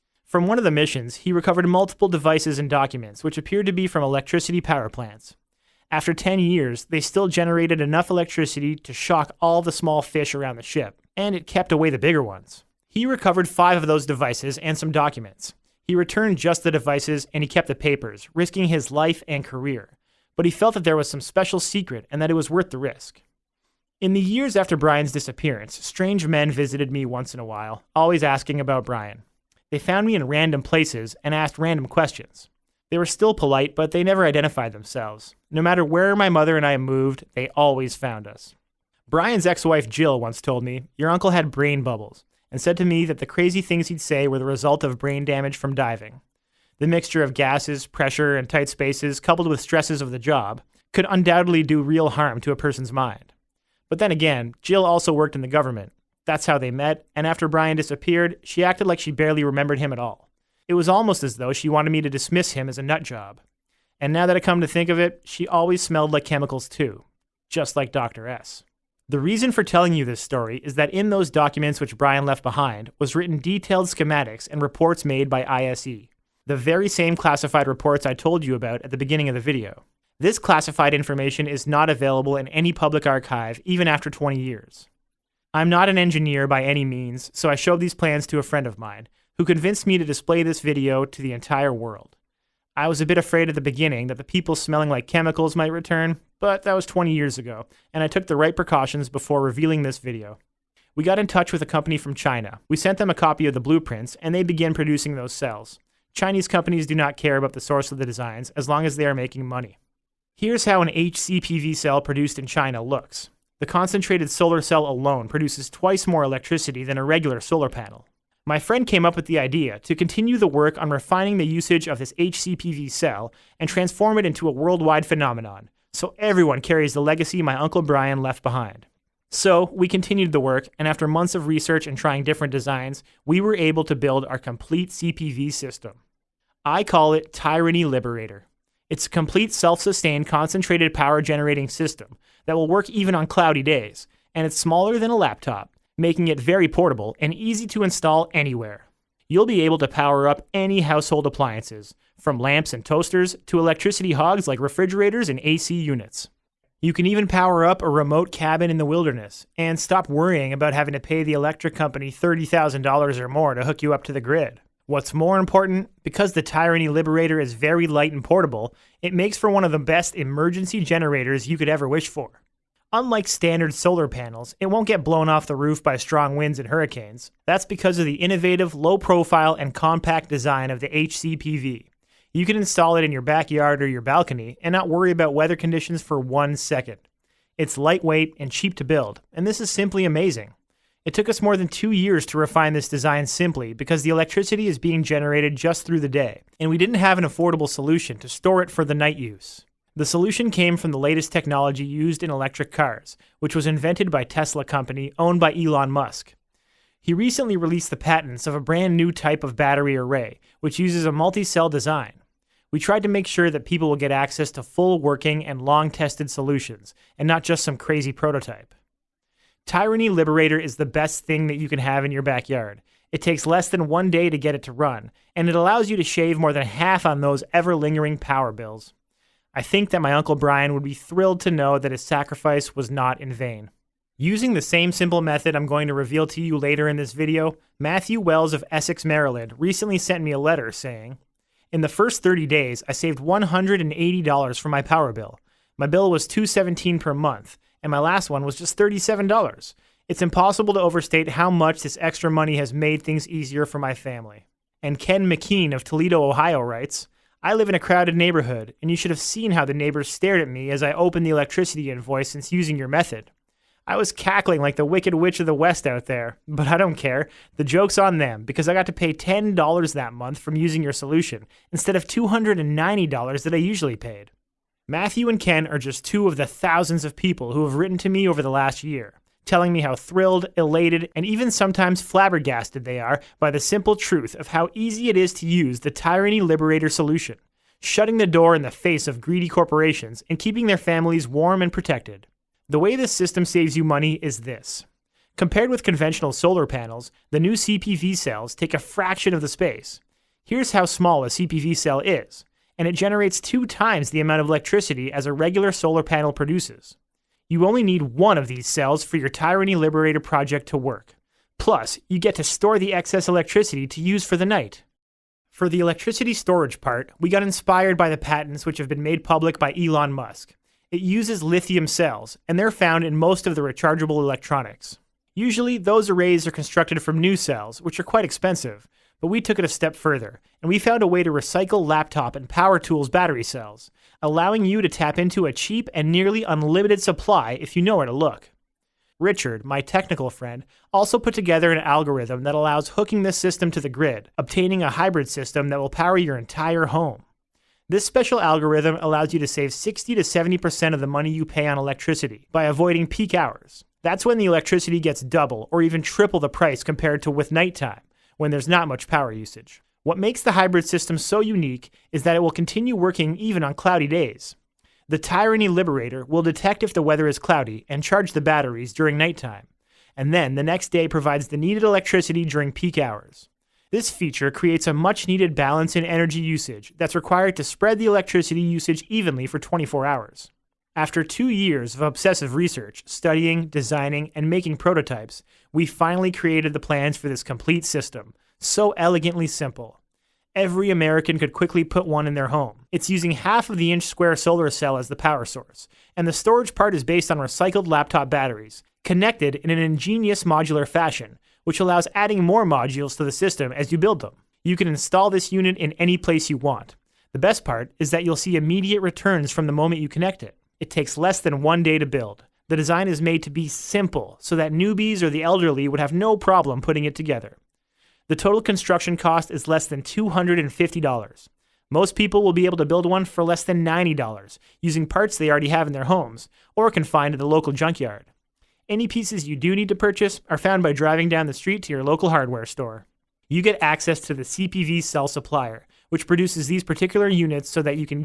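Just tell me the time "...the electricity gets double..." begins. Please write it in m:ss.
5:54.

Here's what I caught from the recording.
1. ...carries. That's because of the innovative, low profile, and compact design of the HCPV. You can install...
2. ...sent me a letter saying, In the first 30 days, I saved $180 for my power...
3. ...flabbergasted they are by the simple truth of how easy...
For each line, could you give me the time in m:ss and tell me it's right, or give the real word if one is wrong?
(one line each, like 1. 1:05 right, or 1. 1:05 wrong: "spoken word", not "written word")
1. 2:56 wrong: "hurricanes", not "carries"
2. 3:59 right
3. 4:42 right.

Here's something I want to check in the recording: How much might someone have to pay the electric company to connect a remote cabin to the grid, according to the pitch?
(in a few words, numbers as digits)
$30,000.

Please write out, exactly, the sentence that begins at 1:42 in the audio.
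We sent them a copy of the blueprints, and they began producing those cells.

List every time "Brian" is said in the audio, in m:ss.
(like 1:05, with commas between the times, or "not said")
0:24, 0:28, 0:39, 0:57, 1:11, 2:07, 3:50.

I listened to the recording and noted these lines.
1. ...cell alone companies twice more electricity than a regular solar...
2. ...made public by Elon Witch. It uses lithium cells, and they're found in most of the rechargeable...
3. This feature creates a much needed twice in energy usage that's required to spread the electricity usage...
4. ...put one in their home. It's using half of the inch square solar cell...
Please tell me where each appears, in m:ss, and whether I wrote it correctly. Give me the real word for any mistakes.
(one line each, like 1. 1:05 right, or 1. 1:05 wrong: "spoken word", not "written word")
1. 1:54 wrong: "produces", not "companies"
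2. 5:19 wrong: "Musk", not "Witch"
3. 6:13 wrong: "balance", not "twice"
4. 6:31 right.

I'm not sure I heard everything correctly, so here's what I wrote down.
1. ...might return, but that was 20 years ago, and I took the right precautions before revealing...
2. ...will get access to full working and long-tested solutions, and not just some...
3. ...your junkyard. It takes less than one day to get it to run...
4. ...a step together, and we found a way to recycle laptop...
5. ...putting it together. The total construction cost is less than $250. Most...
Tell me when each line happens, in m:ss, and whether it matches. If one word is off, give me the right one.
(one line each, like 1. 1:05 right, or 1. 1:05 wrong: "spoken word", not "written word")
1. 1:35 right
2. 3:33 right
3. 3:42 wrong: "backyard", not "junkyard"
4. 5:29 wrong: "further", not "together"
5. 6:56 right.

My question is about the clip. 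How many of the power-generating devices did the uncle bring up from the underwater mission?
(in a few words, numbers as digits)
5.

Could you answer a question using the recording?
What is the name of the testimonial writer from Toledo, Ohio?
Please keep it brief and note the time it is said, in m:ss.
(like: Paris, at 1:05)
Ken McKean, at 4:14.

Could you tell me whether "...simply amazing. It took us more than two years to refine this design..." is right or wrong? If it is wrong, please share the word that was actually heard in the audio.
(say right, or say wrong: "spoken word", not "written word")
right.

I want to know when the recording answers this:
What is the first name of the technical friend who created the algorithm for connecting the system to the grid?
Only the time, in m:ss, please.
5:39.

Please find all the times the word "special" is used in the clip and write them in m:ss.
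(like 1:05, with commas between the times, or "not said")
0:21, 5:48.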